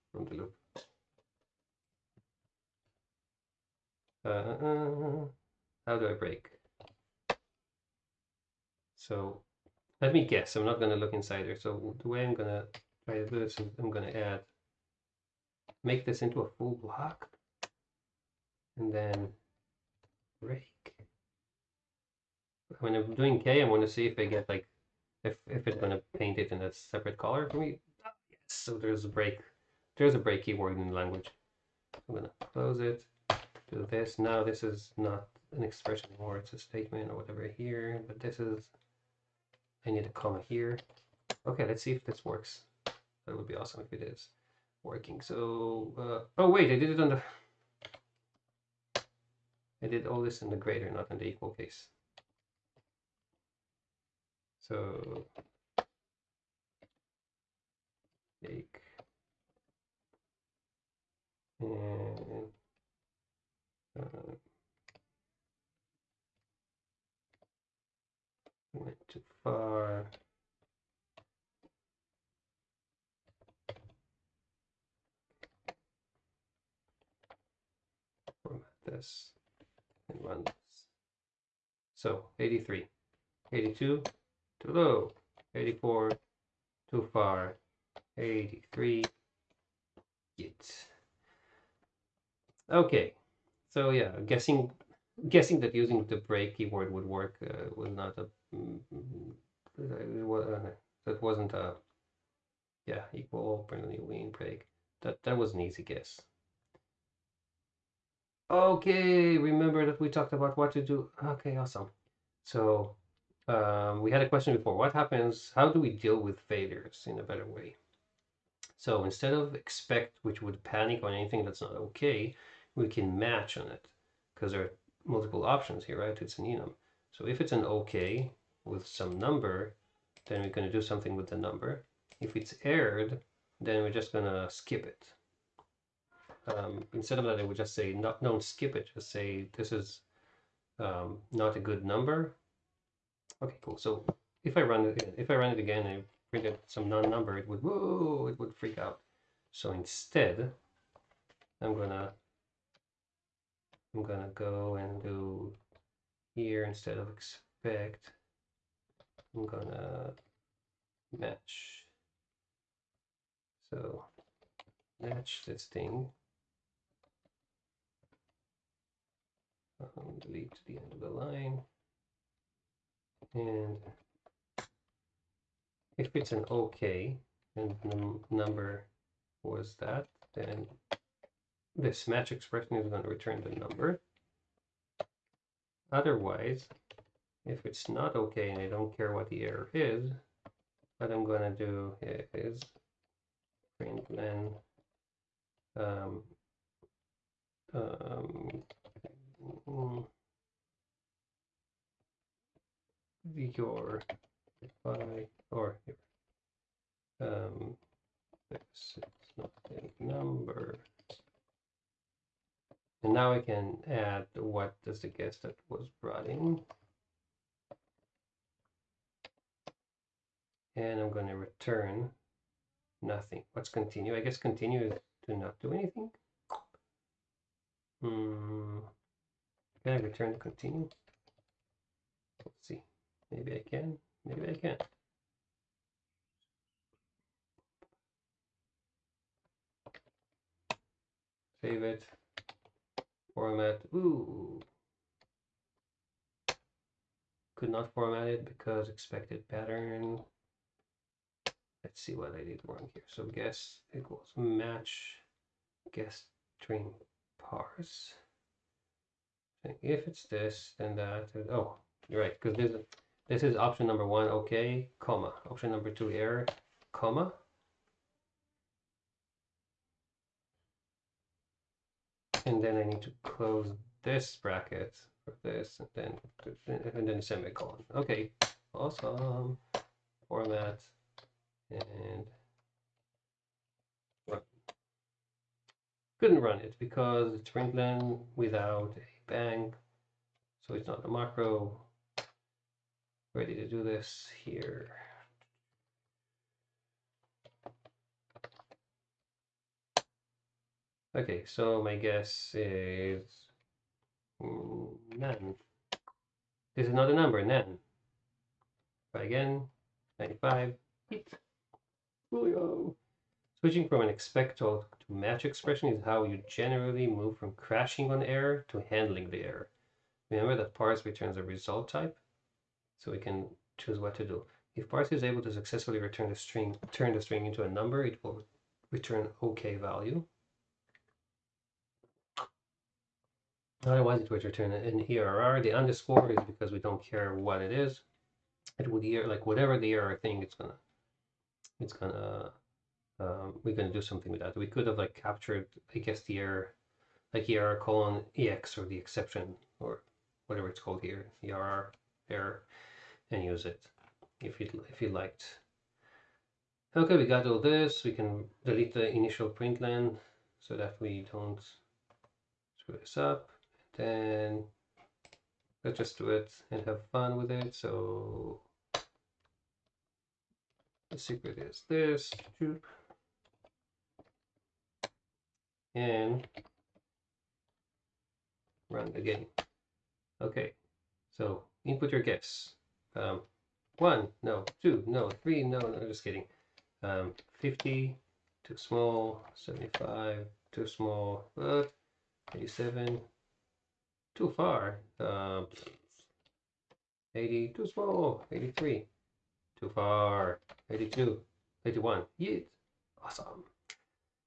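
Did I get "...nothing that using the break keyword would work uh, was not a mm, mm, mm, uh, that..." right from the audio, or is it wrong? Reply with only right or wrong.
wrong.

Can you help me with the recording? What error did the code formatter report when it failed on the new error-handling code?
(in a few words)
expected pattern.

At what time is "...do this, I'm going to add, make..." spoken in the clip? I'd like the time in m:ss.
0:13.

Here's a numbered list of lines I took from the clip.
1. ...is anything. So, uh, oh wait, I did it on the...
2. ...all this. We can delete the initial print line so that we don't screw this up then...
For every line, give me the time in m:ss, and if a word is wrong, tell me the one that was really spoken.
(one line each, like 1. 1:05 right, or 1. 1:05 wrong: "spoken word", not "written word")
1. 0:44 wrong: "working", not "anything"
2. 5:57 right.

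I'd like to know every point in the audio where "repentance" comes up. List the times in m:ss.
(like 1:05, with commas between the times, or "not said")
not said.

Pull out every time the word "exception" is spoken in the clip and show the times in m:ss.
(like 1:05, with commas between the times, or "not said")
5:48.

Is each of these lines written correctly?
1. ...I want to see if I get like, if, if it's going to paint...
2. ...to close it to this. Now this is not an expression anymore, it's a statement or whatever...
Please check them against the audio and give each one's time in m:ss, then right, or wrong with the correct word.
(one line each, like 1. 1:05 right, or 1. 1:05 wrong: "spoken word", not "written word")
1. 0:23 right
2. 0:32 right.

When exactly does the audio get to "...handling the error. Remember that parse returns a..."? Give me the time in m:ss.
5:18.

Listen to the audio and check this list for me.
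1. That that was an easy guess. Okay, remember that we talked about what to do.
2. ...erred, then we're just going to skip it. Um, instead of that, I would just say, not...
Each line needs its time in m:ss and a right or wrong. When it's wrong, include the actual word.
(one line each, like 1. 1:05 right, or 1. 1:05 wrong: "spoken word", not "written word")
1. 1:45 right
2. 2:12 right.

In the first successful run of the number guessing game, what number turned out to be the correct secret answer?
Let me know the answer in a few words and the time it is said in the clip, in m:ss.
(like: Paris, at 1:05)
83, at 1:28.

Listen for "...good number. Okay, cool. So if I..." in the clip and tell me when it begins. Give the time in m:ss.
2:21.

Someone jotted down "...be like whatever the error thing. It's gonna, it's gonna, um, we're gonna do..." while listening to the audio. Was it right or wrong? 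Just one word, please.
right.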